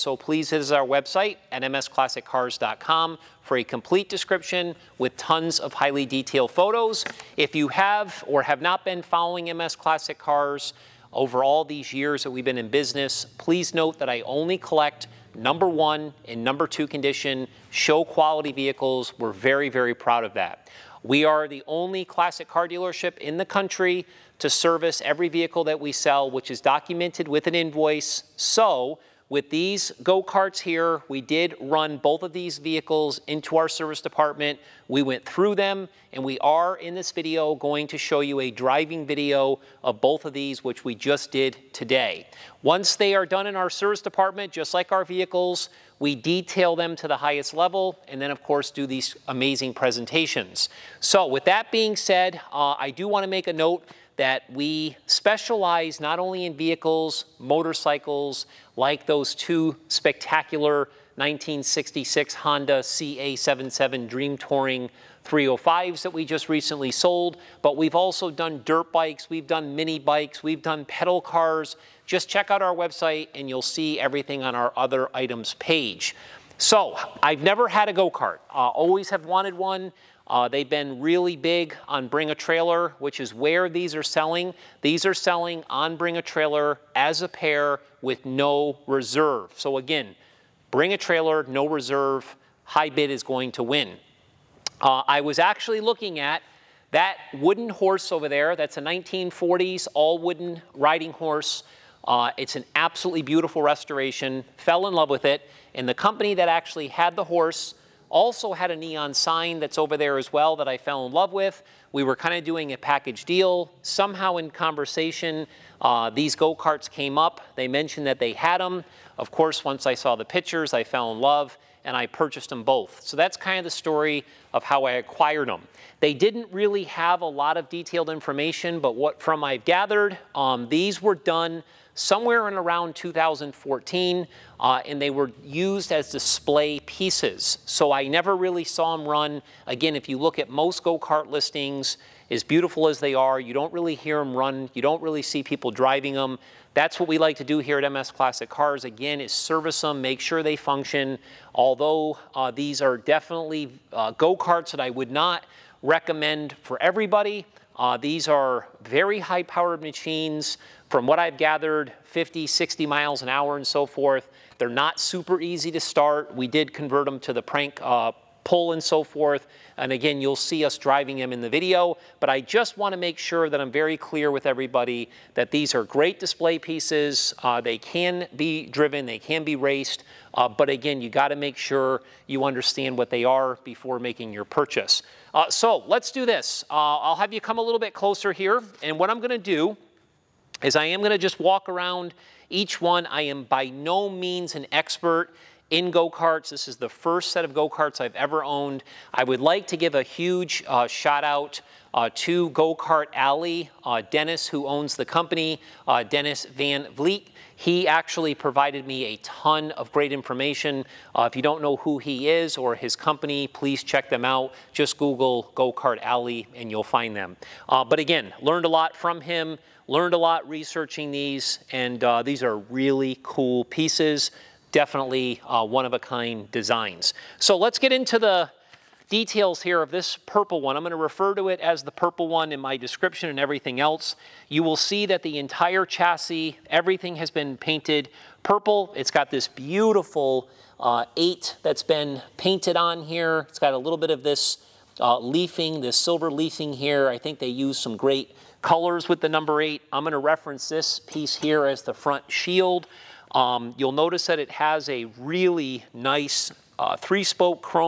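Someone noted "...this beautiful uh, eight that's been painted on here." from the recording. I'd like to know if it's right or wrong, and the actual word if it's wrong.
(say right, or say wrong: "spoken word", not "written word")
right.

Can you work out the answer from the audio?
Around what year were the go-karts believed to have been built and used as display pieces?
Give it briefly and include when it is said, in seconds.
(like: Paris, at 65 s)
2014, at 132 s.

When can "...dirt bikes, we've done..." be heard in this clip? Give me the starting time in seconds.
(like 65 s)
68 s.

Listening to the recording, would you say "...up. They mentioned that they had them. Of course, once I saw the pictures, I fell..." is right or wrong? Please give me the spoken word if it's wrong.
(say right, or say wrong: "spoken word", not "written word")
right.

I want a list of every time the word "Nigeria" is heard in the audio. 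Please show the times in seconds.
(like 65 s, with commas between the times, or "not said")
not said.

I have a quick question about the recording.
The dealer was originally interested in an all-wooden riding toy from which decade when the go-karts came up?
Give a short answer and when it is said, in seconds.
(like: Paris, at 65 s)
1940s, at 98 s.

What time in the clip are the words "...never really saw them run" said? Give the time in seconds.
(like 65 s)
138 s.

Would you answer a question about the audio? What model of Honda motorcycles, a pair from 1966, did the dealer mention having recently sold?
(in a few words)
CA77 Dream Touring 305.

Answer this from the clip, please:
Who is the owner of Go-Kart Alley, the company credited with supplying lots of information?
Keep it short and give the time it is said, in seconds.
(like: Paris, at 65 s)
Dennis Van Vleet, at 206 s.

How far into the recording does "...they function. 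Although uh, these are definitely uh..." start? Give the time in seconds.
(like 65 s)
150 s.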